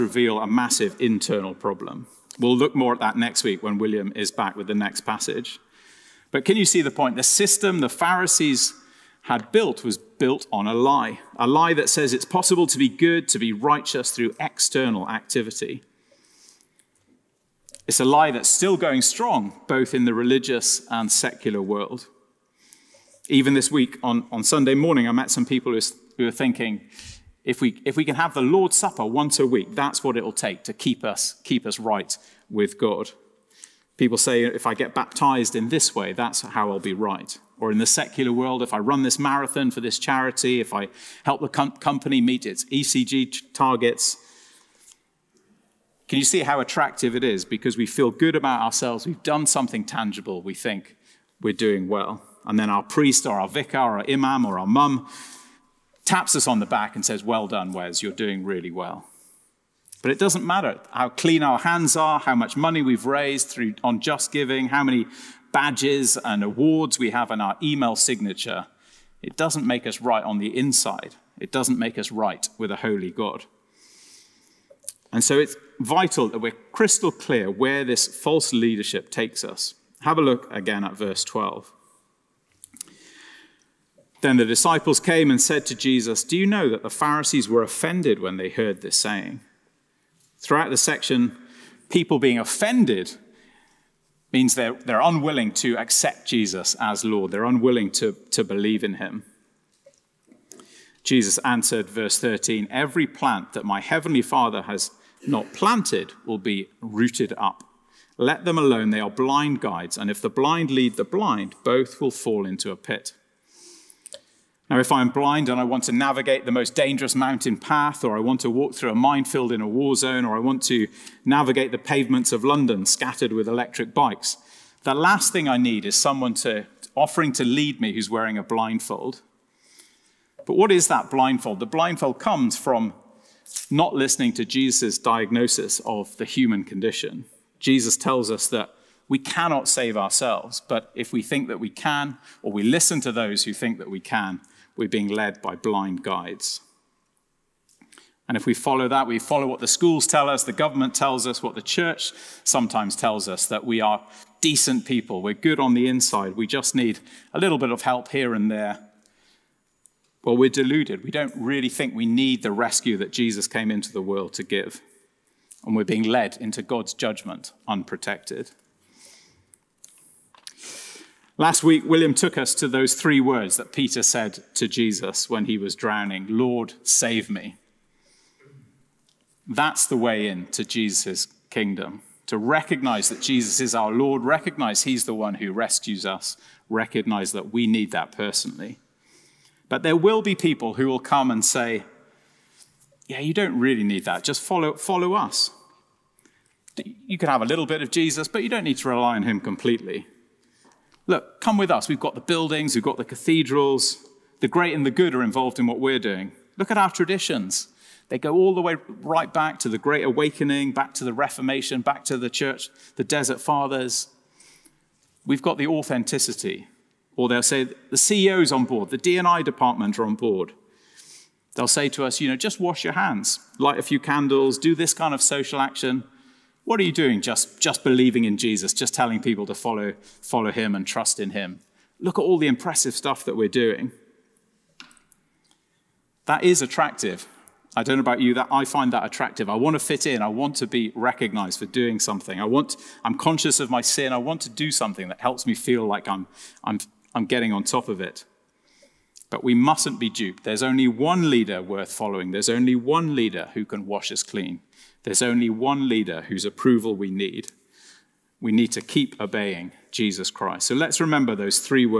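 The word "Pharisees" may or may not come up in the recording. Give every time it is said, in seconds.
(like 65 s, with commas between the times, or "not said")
7 s, 86 s.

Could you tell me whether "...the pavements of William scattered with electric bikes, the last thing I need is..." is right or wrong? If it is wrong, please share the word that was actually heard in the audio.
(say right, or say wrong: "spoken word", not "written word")
wrong: "London", not "William".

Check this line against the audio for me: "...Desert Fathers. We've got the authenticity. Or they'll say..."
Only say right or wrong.
right.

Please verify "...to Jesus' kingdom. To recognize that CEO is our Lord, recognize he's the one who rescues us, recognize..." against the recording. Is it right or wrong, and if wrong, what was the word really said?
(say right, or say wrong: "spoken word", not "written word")
wrong: "Jesus", not "CEO".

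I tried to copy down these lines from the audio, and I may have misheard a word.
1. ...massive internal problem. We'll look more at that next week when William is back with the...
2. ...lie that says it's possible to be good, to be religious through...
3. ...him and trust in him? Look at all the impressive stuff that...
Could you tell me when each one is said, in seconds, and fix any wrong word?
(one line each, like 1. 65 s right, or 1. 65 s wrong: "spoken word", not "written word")
1. 0 s right
2. 11 s wrong: "righteous", not "religious"
3. 230 s right.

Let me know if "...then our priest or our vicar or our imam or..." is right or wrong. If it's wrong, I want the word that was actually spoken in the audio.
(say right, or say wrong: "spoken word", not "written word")
right.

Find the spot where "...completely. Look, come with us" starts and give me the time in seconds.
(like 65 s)
199 s.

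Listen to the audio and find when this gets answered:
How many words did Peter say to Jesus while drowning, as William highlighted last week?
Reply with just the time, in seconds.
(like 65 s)
172 s.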